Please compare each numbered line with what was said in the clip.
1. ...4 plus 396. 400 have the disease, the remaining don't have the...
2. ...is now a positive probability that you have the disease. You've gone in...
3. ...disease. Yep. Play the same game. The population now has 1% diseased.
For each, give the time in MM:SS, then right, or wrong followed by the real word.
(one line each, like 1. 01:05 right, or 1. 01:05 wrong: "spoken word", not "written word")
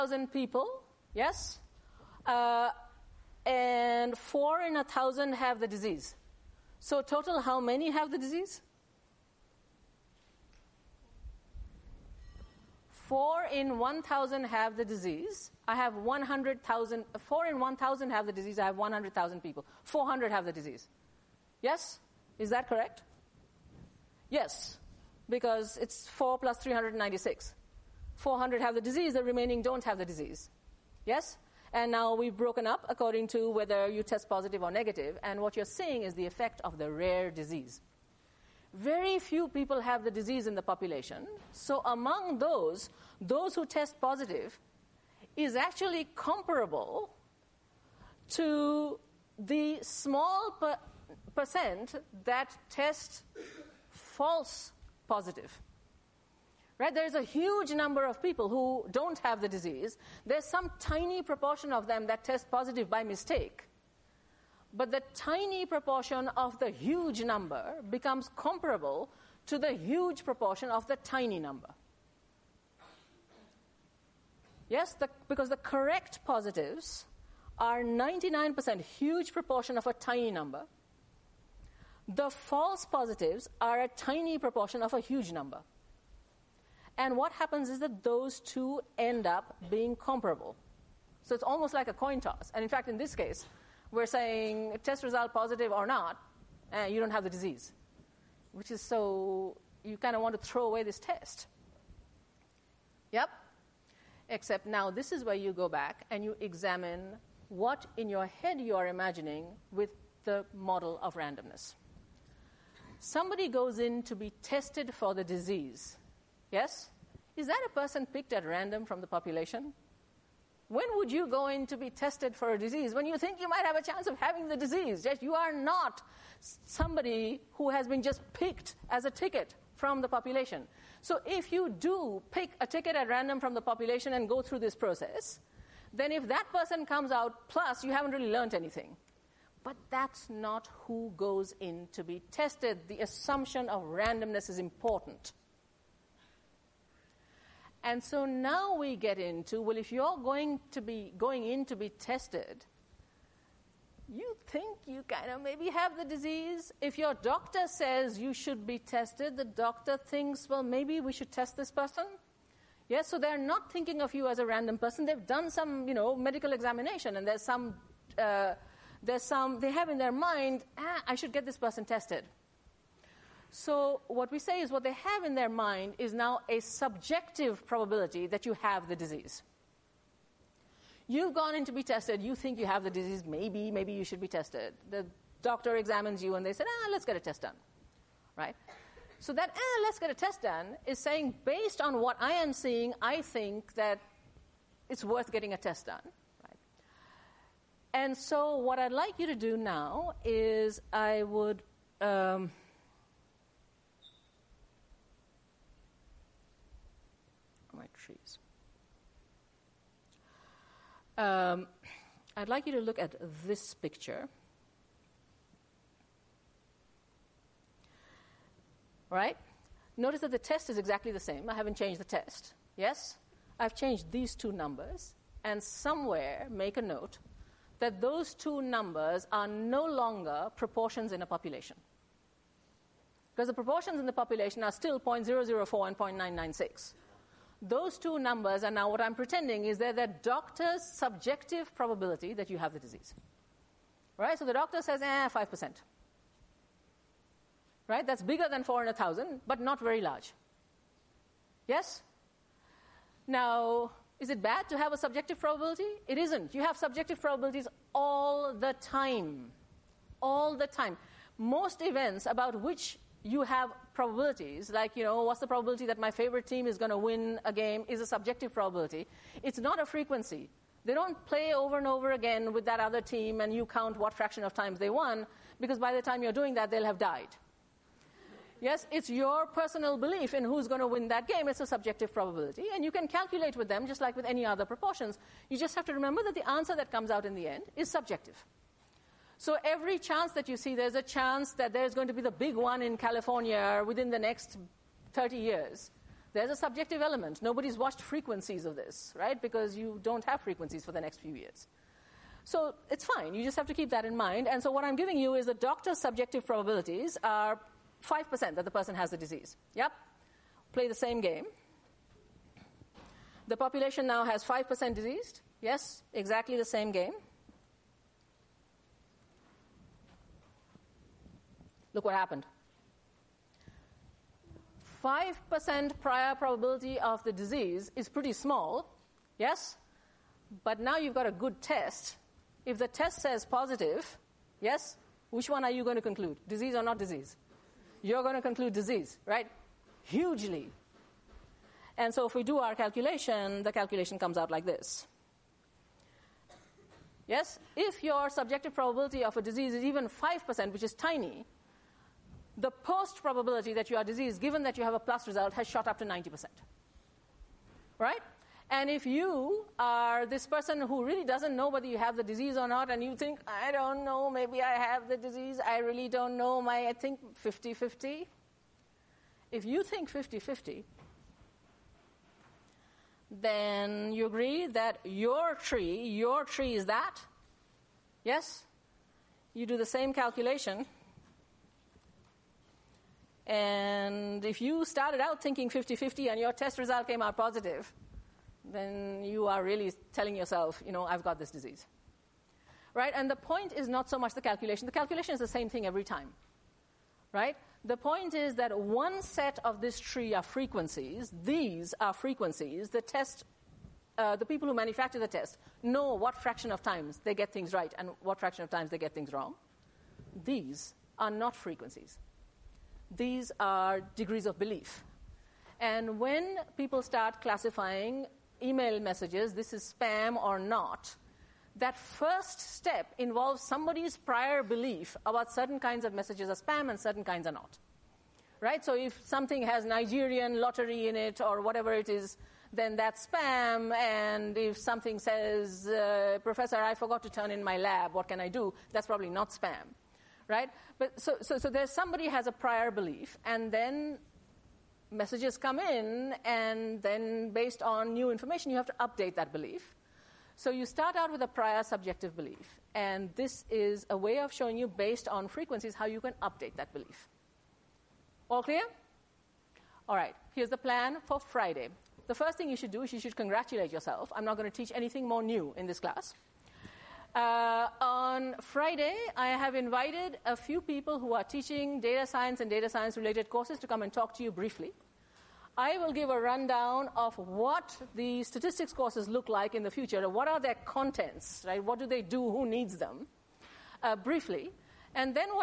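1. 00:26 right
2. 02:55 wrong: "subjective", not "positive"
3. 05:09 wrong: "5", not "1".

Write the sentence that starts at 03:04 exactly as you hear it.
The doctor examines you and they say, ah, let's get a test done, right?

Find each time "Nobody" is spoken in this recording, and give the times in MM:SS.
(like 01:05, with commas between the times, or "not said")
04:57.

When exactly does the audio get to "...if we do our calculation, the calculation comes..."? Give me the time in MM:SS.
05:42.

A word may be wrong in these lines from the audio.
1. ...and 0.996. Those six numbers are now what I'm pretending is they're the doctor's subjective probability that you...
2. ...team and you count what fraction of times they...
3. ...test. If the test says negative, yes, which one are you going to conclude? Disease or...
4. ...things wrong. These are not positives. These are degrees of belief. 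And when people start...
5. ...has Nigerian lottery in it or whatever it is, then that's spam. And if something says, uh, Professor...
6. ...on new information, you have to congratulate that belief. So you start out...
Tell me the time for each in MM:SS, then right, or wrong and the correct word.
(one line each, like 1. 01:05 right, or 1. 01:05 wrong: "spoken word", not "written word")
1. 03:55 wrong: "two", not "six"
2. 04:33 right
3. 05:31 wrong: "positive", not "negative"
4. 06:49 wrong: "frequencies", not "positives"
5. 07:09 right
6. 07:27 wrong: "update", not "congratulate".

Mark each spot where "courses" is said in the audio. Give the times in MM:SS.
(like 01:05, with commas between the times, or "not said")
07:53, 07:58.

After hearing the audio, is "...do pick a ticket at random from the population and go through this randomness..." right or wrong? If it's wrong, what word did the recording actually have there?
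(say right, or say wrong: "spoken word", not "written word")
wrong: "process", not "randomness".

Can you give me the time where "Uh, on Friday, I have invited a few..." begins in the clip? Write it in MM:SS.
07:47.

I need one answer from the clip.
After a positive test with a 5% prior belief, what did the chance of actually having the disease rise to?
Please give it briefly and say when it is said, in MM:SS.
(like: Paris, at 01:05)
90%, at 05:56.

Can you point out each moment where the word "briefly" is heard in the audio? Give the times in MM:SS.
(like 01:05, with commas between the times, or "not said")
07:54, 08:04.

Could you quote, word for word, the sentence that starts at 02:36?
If your doctor says you should be tested, the doctor thinks, well, maybe we should test this person.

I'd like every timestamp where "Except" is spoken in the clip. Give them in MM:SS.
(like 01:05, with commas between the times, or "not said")
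01:44.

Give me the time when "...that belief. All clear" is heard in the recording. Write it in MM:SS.
07:36.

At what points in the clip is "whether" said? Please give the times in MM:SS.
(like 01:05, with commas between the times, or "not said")
00:33, 06:01.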